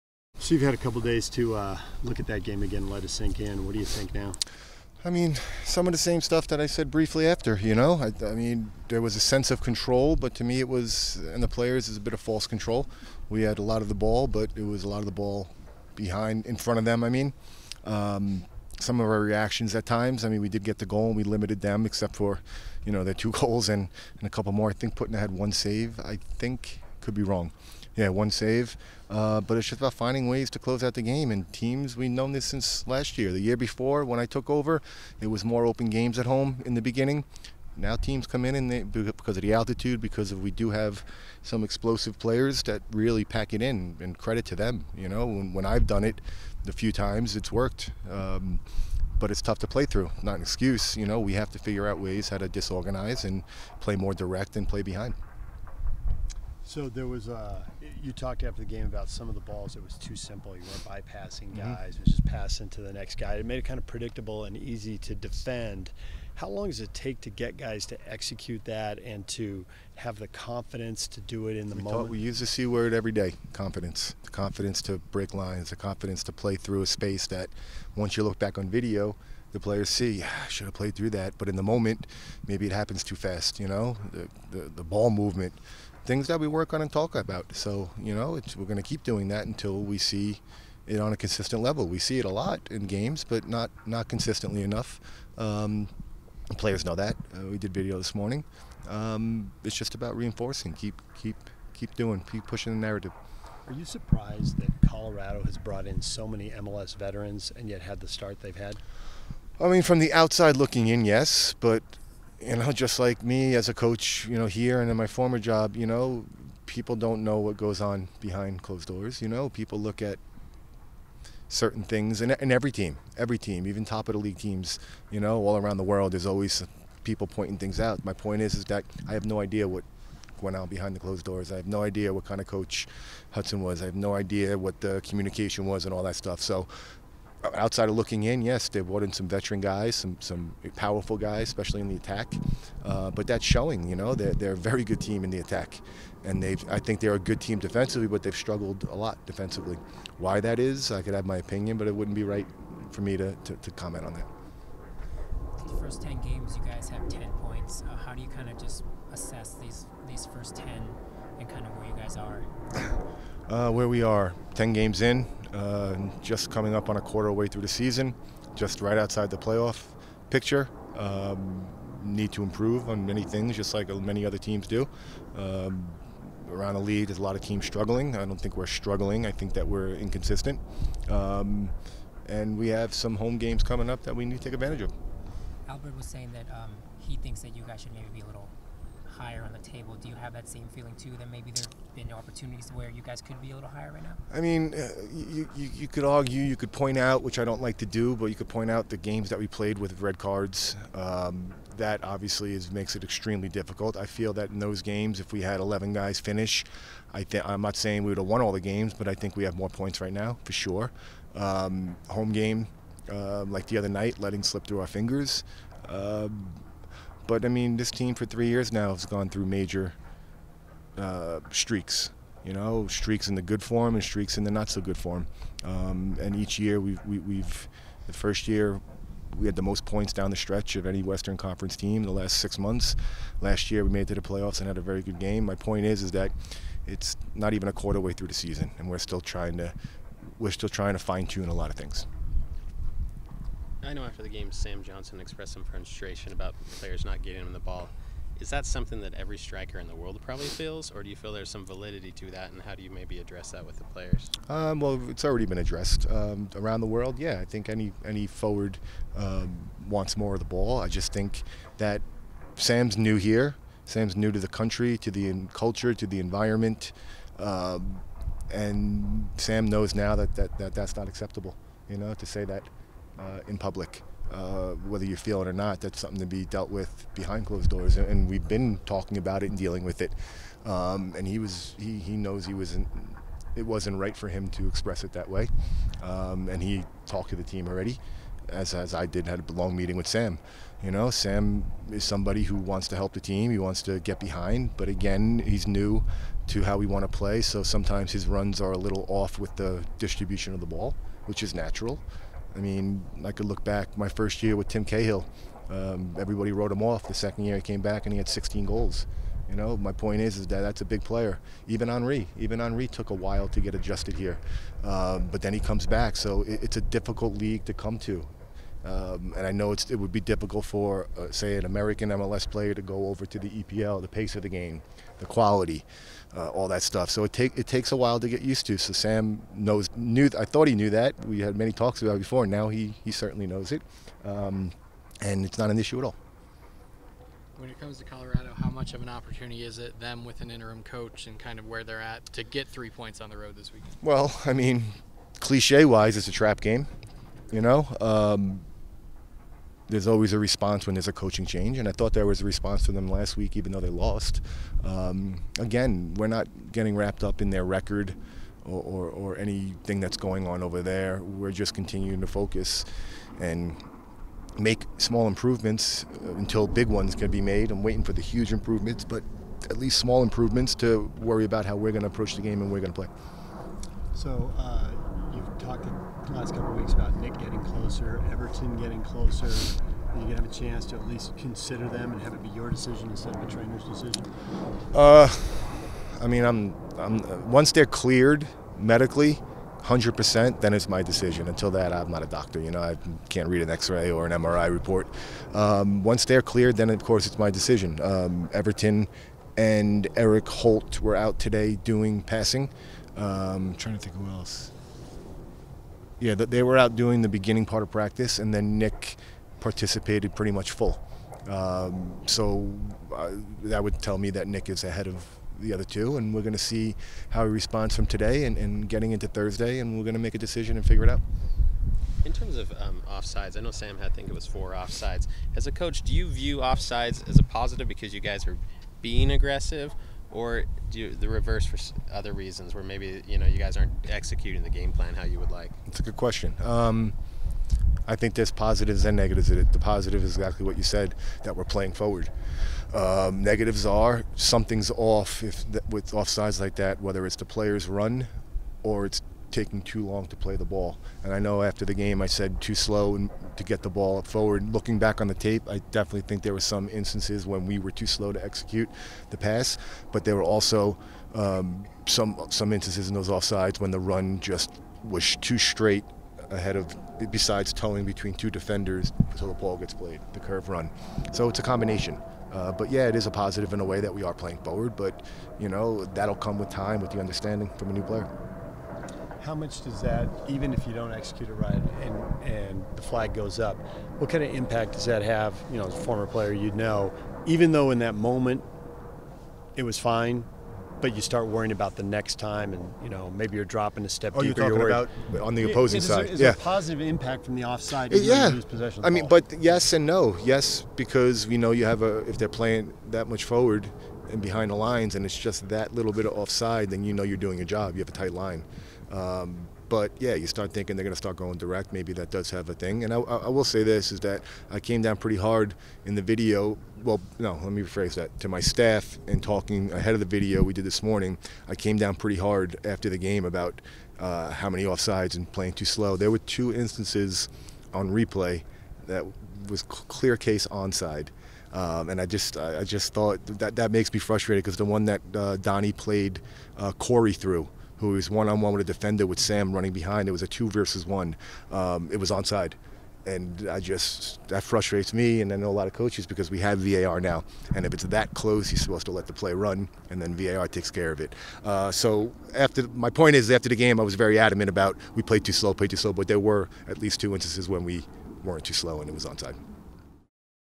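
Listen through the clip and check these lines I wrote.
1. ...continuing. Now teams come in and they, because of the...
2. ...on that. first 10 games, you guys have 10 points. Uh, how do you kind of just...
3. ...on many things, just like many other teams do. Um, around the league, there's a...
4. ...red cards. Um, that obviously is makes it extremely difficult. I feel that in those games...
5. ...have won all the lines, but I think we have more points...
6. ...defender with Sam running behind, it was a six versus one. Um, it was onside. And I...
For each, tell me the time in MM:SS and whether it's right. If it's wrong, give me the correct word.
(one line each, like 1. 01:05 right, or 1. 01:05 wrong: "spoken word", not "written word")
1. 00:36 wrong: "beginning", not "continuing"
2. 02:34 right
3. 02:52 right
4. 03:20 right
5. 03:28 wrong: "games", not "lines"
6. 08:58 wrong: "two", not "six".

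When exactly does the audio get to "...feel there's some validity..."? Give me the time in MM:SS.
04:11.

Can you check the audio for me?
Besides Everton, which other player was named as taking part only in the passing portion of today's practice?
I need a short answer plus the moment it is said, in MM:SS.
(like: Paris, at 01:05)
Erik Holt, at 06:40.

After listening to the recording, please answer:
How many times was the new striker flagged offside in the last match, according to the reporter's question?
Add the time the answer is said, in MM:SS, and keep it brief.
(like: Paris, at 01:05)
4, at 07:04.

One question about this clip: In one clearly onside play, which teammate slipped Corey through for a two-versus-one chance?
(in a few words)
Donnie.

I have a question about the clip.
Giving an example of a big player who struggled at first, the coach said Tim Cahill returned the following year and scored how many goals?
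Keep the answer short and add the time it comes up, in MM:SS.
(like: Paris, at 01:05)
16, at 05:08.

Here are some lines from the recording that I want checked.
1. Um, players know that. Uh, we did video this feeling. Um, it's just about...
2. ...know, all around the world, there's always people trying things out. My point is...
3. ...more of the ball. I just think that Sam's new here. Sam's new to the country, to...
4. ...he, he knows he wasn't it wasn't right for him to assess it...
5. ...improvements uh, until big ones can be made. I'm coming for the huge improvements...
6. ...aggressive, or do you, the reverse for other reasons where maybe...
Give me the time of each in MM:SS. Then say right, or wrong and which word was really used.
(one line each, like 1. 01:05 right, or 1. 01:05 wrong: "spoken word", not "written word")
1. 01:35 wrong: "morning", not "feeling"
2. 02:05 wrong: "pointing", not "trying"
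3. 04:20 right
4. 04:41 wrong: "express", not "assess"
5. 06:05 wrong: "waiting", not "coming"
6. 07:09 right.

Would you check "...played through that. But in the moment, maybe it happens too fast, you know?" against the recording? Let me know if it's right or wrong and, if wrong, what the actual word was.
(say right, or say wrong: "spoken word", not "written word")
right.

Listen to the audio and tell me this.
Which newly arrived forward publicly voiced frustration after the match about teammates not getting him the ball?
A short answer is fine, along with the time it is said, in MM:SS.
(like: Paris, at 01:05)
Sam Johnson, at 04:04.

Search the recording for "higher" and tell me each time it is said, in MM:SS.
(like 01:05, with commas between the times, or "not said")
03:09, 03:13.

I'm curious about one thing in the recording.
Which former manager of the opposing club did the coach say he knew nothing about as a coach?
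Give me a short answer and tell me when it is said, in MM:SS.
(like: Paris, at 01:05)
Hudson, at 02:13.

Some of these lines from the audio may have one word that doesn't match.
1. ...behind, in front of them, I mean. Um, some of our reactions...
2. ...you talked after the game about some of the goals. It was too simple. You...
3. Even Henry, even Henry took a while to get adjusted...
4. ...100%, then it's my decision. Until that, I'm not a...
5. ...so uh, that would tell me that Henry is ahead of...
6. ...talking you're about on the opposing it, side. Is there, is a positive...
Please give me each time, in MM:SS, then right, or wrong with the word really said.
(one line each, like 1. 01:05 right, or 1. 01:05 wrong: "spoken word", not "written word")
1. 00:15 right
2. 00:58 wrong: "balls", not "goals"
3. 05:11 right
4. 06:29 right
5. 06:52 wrong: "Nick", not "Henry"
6. 08:14 right.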